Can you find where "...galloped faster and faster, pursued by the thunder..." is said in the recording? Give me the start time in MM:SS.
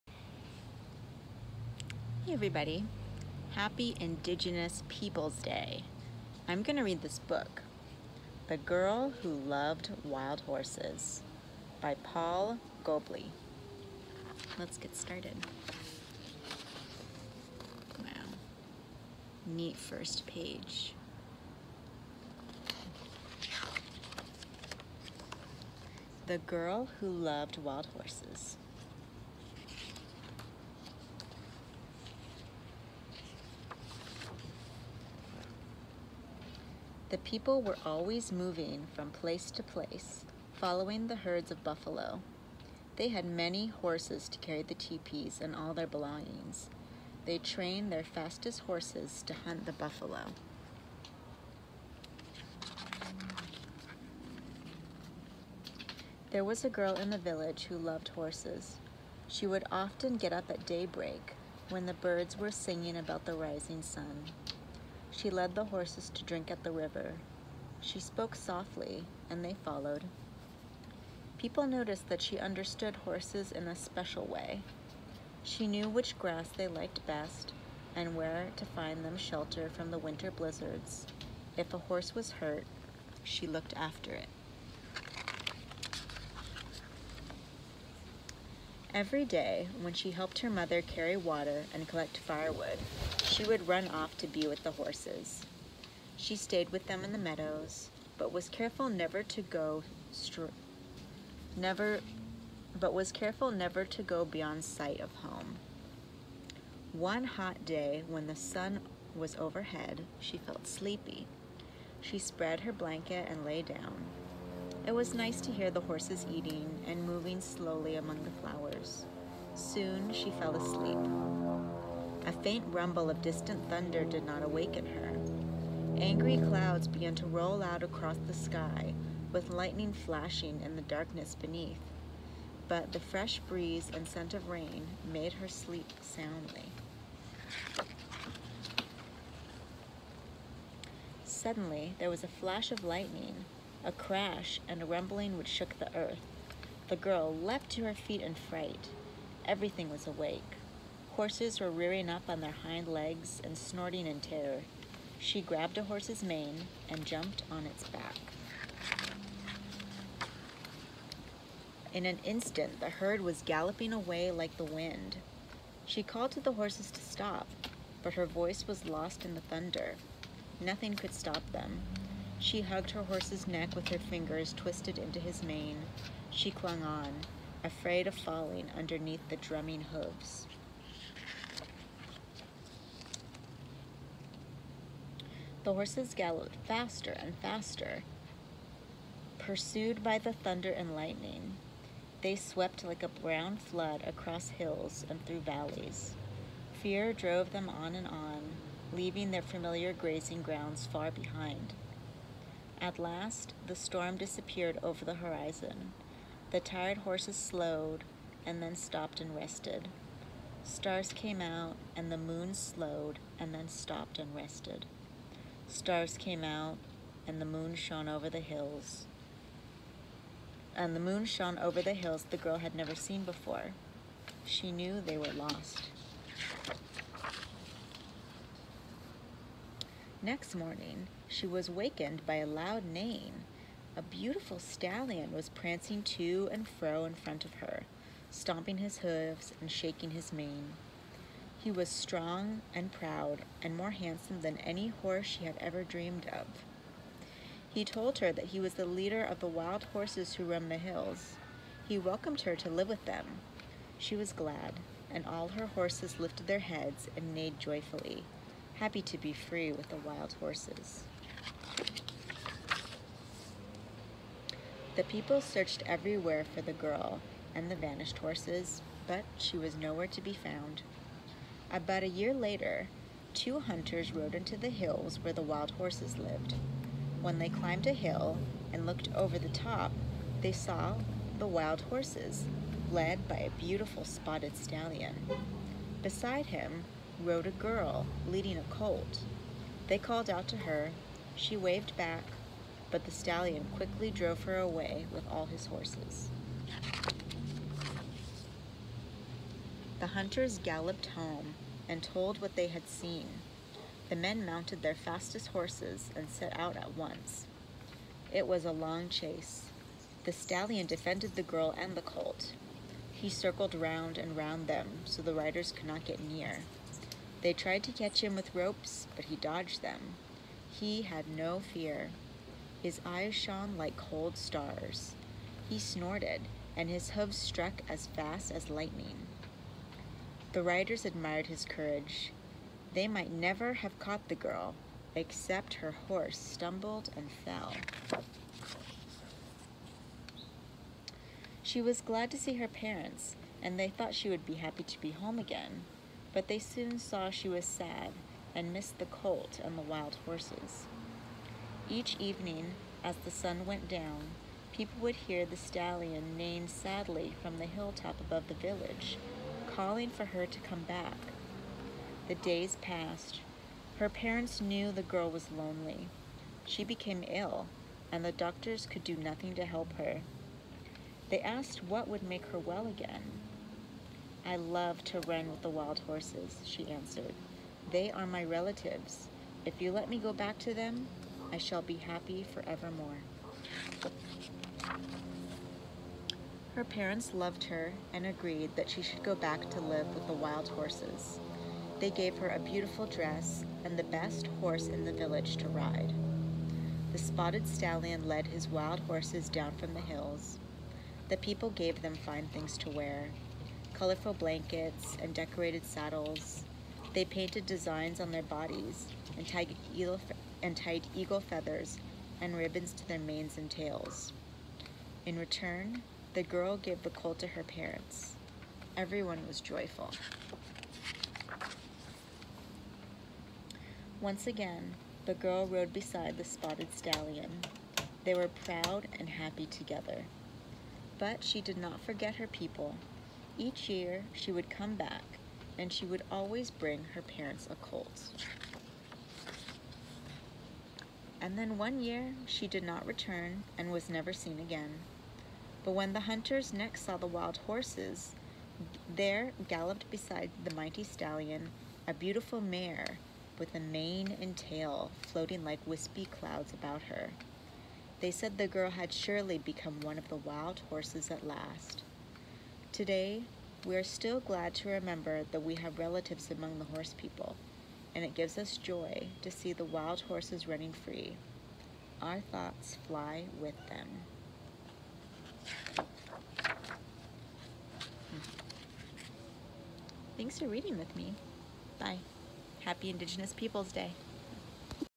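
03:06.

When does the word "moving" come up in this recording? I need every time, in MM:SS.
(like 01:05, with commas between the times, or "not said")
00:38, 01:57.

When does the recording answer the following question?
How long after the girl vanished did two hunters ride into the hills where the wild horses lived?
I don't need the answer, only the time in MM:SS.
04:31.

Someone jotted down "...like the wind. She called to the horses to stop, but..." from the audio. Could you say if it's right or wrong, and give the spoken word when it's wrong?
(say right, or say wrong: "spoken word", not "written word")
right.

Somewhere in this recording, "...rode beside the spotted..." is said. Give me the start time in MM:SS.
07:05.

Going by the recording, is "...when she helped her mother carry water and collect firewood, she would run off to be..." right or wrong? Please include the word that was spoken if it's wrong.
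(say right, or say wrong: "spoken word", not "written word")
right.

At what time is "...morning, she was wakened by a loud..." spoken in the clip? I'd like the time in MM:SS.
03:50.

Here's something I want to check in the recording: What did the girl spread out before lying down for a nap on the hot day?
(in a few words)
her blanket.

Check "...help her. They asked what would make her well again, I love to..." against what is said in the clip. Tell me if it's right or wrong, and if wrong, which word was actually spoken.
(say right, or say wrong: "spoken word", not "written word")
right.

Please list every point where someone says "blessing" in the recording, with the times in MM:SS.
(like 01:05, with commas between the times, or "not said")
not said.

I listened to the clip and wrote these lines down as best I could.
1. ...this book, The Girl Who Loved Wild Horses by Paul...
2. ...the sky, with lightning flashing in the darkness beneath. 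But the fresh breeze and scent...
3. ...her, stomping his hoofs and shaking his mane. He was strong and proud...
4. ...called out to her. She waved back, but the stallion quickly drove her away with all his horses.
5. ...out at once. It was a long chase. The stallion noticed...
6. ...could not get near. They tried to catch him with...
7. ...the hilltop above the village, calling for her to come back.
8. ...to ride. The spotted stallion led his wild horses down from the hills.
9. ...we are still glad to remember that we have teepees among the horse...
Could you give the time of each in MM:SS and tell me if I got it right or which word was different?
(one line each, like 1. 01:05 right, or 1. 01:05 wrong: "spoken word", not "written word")
1. 00:07 right
2. 02:08 right
3. 03:57 right
4. 04:49 right
5. 05:06 wrong: "defended", not "noticed"
6. 05:15 right
7. 05:57 right
8. 06:35 right
9. 07:43 wrong: "relatives", not "teepees".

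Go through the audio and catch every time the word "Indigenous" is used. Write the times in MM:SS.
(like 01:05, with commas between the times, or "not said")
00:03, 08:03.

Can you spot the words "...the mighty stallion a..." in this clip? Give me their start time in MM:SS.
07:30.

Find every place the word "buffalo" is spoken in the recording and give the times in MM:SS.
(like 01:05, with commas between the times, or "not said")
00:41, 00:49.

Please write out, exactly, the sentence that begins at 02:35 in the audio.
She grabbed a horse's mane and jumped on its back.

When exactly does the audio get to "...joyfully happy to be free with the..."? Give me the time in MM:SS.
04:17.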